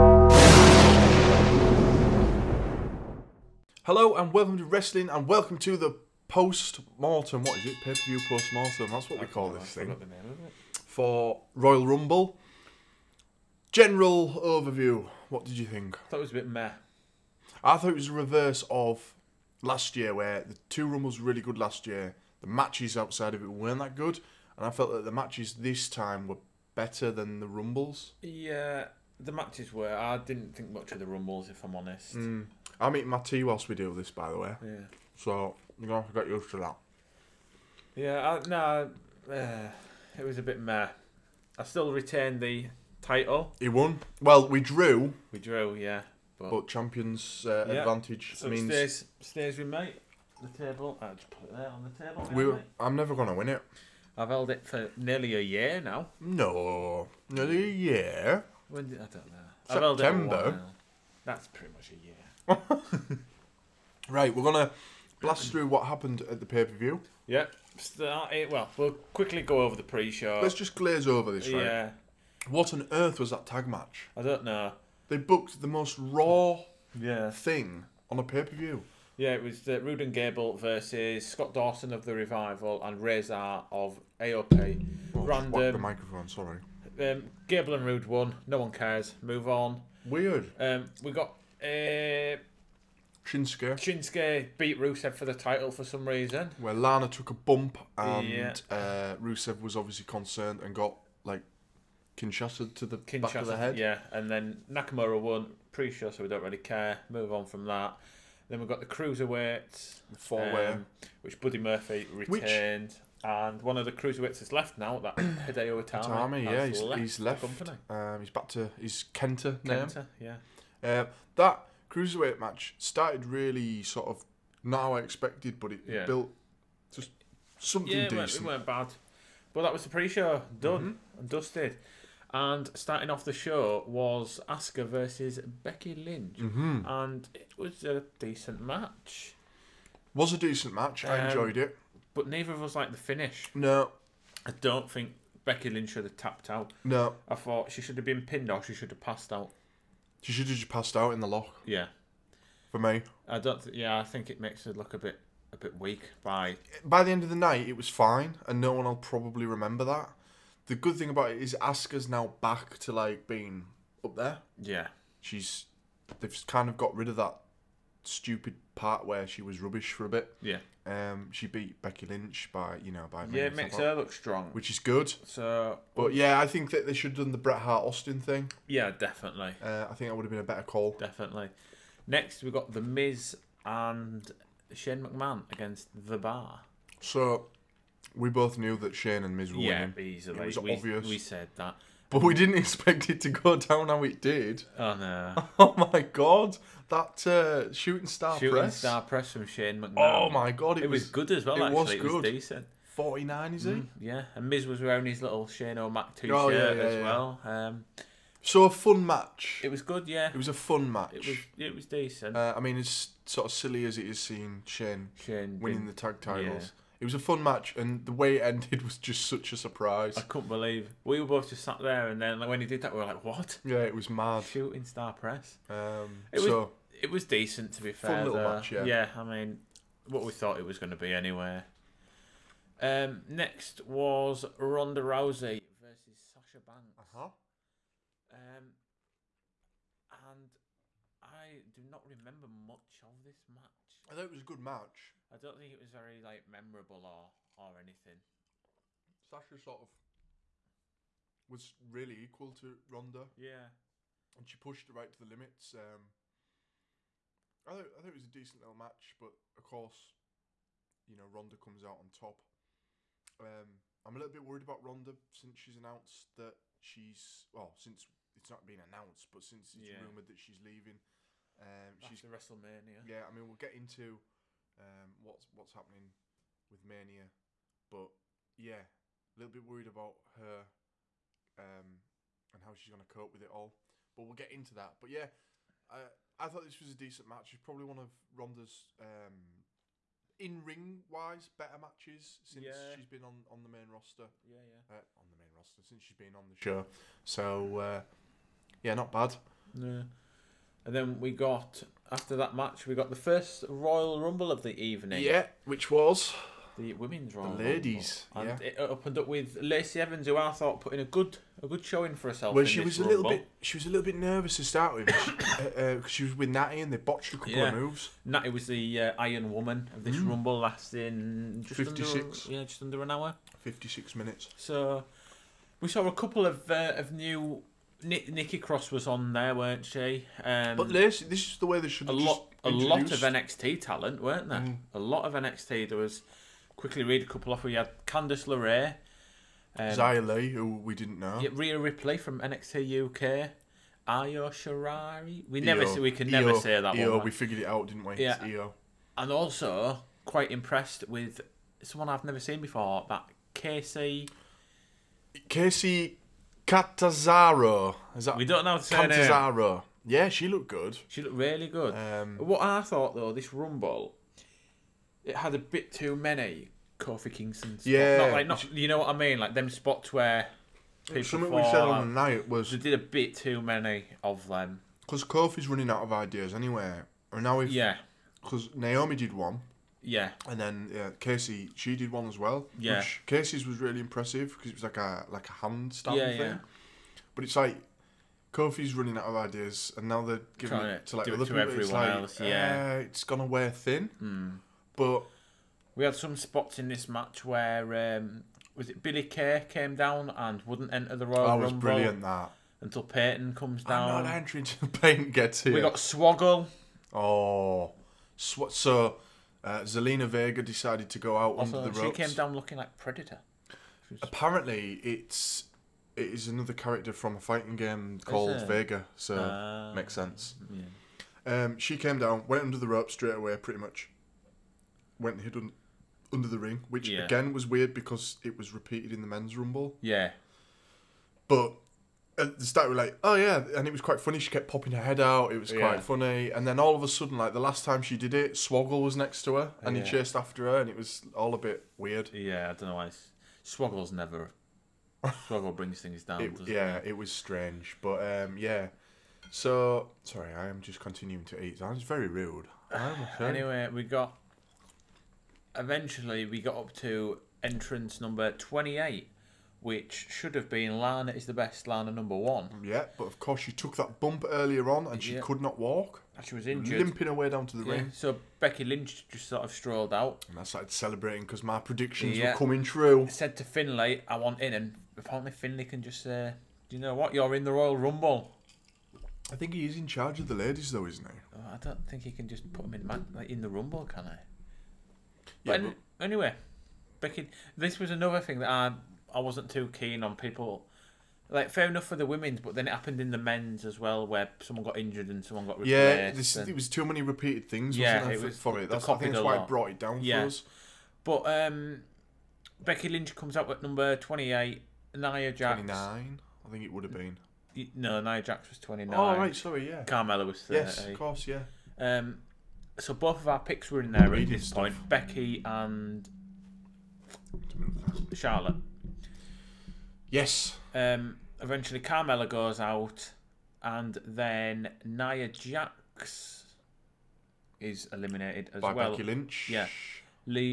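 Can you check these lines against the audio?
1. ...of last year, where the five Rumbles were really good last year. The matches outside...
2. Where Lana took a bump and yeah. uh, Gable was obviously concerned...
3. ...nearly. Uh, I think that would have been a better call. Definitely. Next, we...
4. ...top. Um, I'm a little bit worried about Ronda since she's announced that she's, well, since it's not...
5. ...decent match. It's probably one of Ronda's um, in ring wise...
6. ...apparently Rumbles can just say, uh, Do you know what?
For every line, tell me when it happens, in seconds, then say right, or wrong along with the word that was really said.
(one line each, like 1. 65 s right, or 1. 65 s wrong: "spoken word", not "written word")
1. 18 s wrong: "two", not "five"
2. 96 s wrong: "Rusev", not "Gable"
3. 178 s wrong: "definitely", not "nearly"
4. 262 s right
5. 286 s right
6. 475 s wrong: "Finlay", not "Rumbles".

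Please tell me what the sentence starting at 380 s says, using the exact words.
And then yeah, Kacy, she did one as well.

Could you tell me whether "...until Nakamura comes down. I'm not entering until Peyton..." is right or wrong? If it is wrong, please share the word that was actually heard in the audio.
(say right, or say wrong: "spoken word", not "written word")
wrong: "Peyton", not "Nakamura".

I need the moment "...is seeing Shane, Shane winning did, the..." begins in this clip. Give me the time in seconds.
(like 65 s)
214 s.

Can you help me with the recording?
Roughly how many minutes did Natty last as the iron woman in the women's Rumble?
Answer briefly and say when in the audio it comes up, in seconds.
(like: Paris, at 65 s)
56, at 323 s.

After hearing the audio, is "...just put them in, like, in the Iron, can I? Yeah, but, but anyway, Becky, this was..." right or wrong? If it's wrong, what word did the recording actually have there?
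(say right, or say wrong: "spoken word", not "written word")
wrong: "Rumble", not "Iron".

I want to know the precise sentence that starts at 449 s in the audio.
So sorry, I am just continuing to eat.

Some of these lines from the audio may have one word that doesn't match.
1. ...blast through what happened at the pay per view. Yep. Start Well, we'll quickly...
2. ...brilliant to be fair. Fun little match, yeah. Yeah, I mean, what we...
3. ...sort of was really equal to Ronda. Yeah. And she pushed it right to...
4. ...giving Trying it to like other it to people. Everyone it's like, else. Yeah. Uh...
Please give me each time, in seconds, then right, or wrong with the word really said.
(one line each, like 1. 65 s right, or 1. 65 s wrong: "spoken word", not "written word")
1. 65 s right
2. 227 s wrong: "decent", not "brilliant"
3. 249 s right
4. 390 s right.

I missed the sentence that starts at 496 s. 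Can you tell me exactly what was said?
it was too many repeated things.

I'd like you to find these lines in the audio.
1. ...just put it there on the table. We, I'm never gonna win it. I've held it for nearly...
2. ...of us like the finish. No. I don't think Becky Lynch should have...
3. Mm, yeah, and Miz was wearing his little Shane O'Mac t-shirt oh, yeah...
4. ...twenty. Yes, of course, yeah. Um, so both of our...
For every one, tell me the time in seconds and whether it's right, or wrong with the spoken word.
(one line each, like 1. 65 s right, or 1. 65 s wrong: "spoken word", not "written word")
1. 51 s right
2. 142 s right
3. 203 s right
4. 510 s wrong: "thirty", not "twenty".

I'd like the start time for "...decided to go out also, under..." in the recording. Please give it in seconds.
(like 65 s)
410 s.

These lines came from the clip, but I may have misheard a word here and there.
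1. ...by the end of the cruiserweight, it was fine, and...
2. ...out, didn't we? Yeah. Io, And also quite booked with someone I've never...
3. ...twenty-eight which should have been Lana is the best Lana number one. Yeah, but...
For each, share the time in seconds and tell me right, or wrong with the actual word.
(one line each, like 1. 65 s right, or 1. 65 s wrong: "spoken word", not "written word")
1. 156 s wrong: "night", not "cruiserweight"
2. 347 s wrong: "impressed", not "booked"
3. 458 s right.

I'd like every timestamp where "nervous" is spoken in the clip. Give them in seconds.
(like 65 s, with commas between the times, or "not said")
314 s.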